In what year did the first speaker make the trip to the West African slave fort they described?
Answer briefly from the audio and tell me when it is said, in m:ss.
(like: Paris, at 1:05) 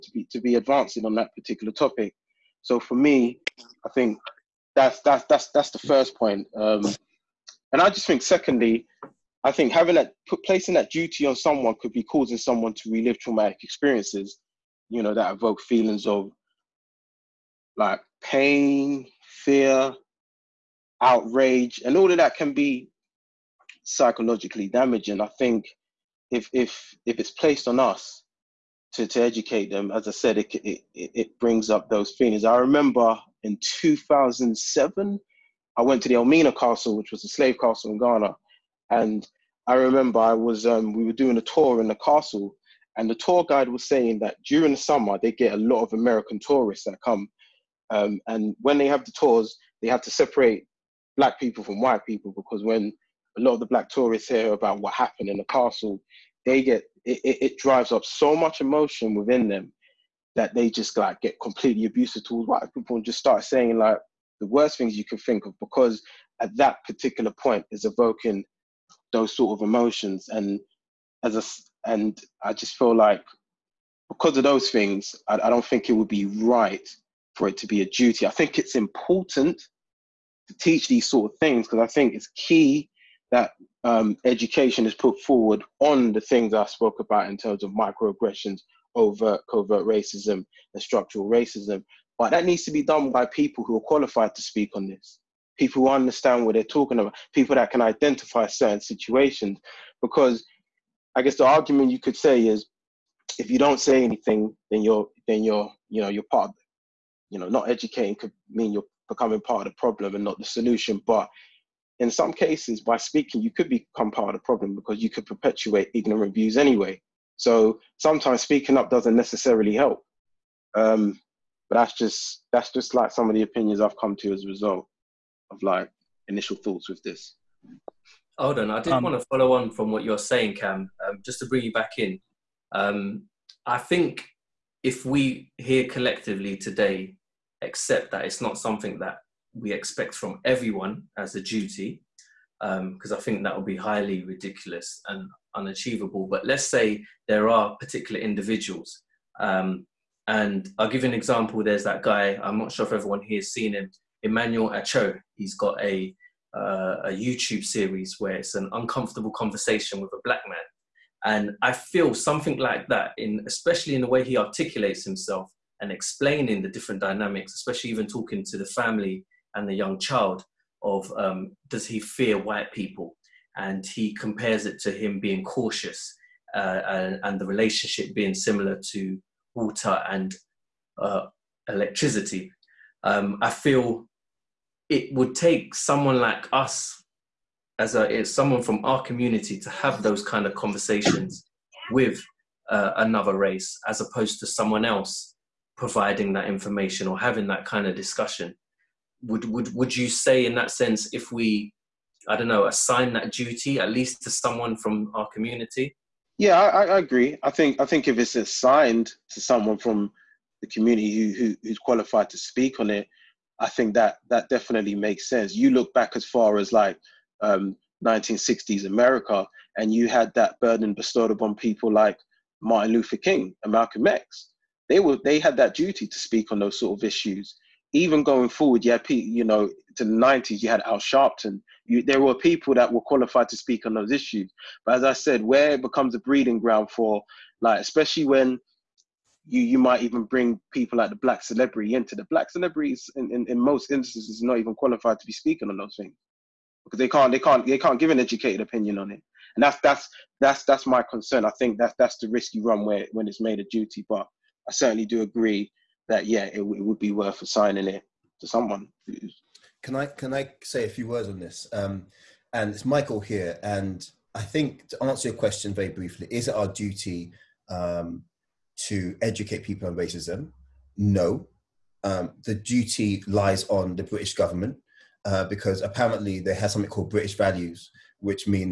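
2007, at 0:33.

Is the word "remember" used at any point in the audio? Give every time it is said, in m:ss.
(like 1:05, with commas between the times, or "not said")
0:32, 0:39.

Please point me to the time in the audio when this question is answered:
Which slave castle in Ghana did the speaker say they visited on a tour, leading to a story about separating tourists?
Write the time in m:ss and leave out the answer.
0:36.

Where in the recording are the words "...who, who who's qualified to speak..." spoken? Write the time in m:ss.
3:31.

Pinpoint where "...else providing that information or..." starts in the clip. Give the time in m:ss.
3:14.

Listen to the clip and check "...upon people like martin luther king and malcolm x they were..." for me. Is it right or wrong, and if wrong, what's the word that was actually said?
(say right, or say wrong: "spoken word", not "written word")
right.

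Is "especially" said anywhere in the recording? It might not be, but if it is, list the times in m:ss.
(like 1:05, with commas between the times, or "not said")
2:43, 2:47, 3:57.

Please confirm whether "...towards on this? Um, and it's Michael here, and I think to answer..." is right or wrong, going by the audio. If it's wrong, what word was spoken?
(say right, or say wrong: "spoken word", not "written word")
wrong: "words", not "towards".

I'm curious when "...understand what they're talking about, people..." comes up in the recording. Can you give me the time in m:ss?
1:35.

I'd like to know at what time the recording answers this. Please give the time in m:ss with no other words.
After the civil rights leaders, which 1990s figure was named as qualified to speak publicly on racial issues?
3:50.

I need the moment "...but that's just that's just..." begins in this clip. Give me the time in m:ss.
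2:01.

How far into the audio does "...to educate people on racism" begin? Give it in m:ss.
4:28.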